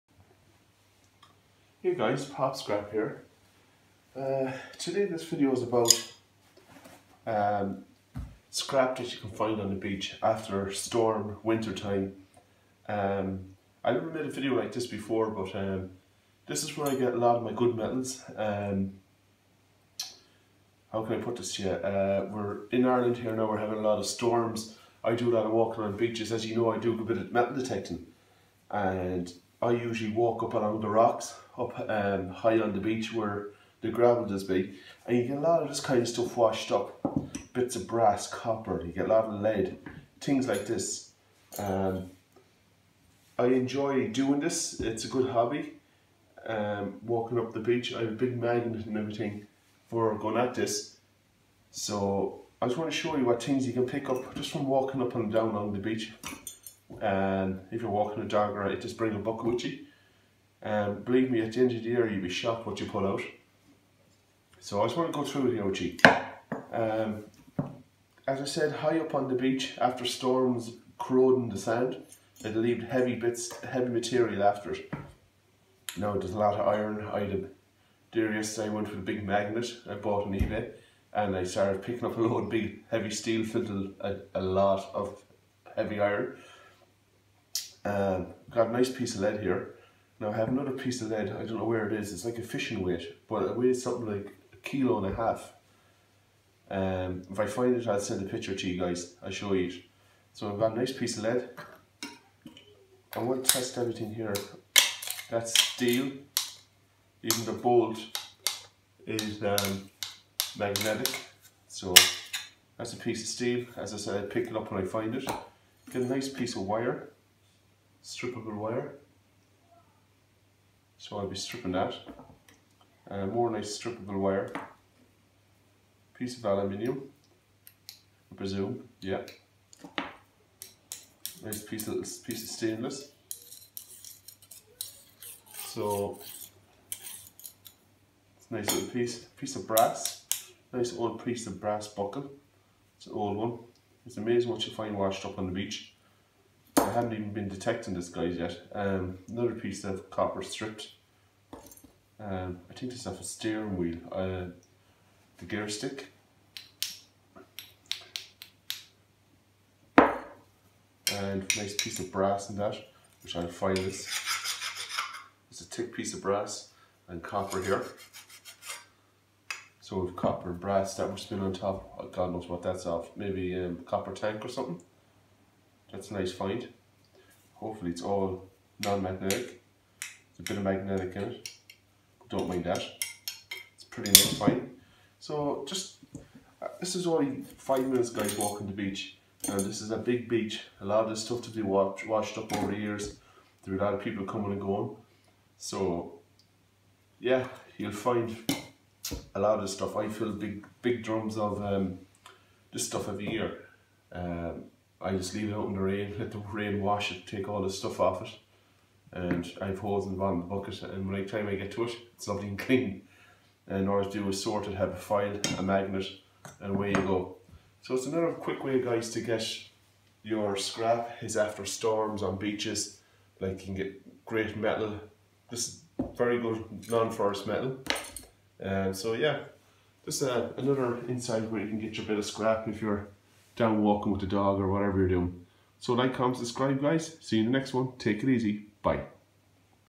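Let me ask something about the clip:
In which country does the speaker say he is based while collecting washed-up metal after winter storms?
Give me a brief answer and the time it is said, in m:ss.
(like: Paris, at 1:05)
Ireland, at 0:22.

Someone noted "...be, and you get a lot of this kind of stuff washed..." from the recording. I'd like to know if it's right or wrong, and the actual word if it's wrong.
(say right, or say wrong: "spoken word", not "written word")
right.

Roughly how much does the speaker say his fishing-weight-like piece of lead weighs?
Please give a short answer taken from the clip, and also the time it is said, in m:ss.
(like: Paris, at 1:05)
1.5 kilos, at 1:34.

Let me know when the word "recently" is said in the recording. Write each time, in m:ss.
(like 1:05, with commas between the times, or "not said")
not said.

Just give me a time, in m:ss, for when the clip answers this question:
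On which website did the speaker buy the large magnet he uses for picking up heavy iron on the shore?
1:20.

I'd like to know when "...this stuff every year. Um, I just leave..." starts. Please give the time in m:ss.
3:22.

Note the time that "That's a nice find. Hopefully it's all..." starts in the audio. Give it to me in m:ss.
2:55.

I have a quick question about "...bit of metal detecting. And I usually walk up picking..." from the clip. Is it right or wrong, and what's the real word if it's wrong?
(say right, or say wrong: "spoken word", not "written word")
wrong: "along", not "picking".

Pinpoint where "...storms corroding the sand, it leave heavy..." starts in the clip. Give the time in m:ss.
1:10.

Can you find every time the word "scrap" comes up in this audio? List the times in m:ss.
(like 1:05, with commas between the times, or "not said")
0:02, 0:08, 3:40, 3:52.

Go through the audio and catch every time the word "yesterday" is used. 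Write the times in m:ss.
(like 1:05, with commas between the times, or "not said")
1:18.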